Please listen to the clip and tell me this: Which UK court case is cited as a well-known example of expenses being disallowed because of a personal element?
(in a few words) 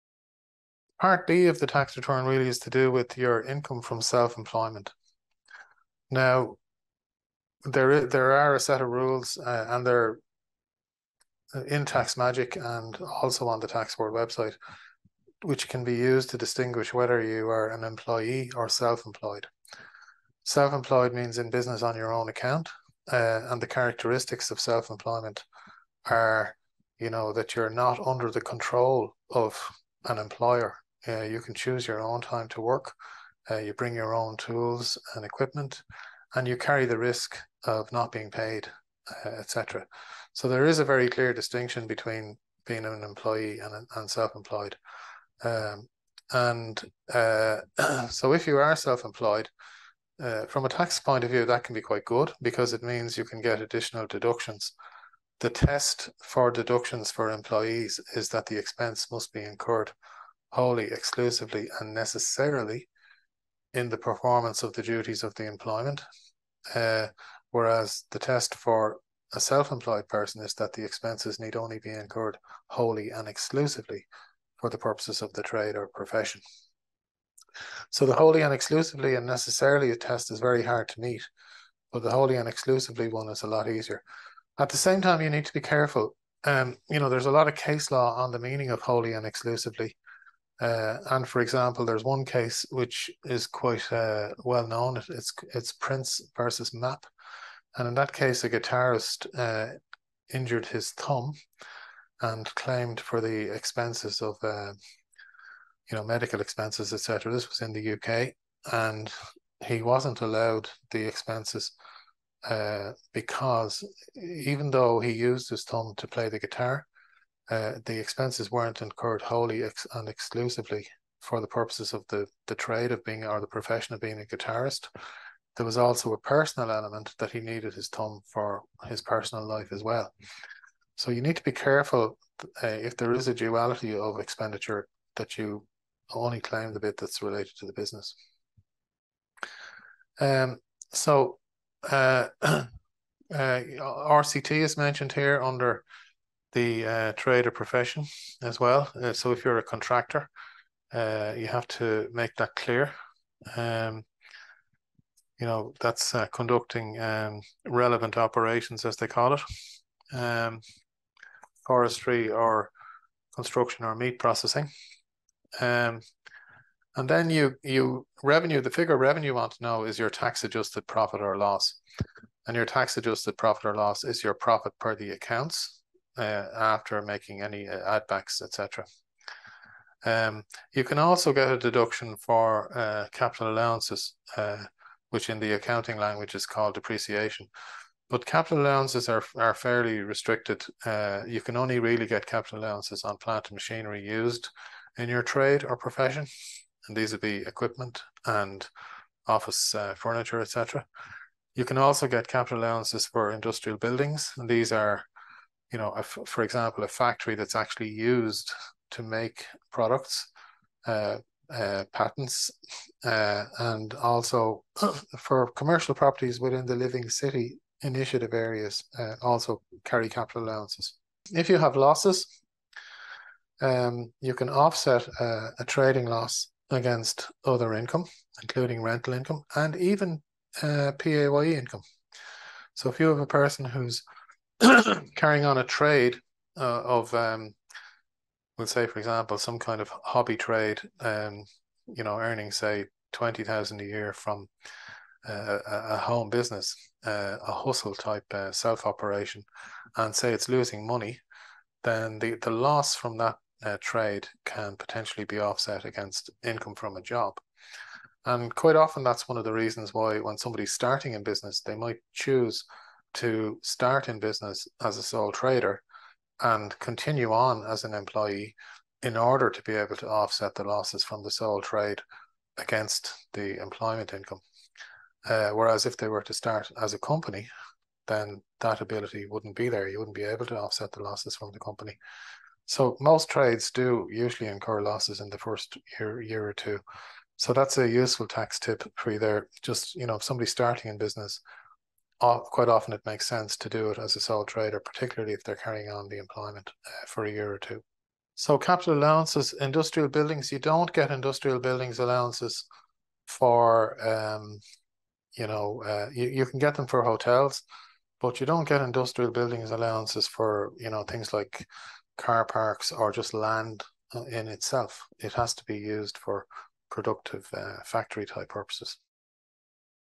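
Prince versus Mapp.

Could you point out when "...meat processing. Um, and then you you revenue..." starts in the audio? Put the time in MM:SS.
02:43.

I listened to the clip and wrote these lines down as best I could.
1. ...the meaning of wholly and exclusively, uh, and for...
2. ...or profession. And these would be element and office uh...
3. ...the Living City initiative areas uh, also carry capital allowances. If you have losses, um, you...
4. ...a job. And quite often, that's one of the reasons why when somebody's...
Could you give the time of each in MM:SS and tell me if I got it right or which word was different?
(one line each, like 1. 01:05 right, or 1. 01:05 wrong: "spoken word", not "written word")
1. 01:28 right
2. 03:15 wrong: "equipment", not "element"
3. 03:36 right
4. 04:16 right.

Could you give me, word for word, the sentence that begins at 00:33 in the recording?
Uh, you bring your own tools and equipment, and you carry the risk of not being paid, uh, etc.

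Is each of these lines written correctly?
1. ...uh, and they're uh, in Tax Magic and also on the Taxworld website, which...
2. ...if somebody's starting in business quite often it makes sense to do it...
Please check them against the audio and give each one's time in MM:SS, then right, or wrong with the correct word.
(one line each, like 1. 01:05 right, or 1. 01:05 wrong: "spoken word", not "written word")
1. 00:09 right
2. 04:50 right.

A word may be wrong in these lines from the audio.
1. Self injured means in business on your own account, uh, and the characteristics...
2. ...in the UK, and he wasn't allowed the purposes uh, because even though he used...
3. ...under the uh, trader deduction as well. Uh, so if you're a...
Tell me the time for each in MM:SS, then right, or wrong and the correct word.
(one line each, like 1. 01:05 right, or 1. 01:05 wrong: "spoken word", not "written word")
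1. 00:20 wrong: "employed", not "injured"
2. 01:47 wrong: "expenses", not "purposes"
3. 02:25 wrong: "profession", not "deduction".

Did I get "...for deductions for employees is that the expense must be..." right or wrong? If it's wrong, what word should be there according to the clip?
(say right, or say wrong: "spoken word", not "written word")
right.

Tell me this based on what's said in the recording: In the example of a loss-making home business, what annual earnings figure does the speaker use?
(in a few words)
20,000.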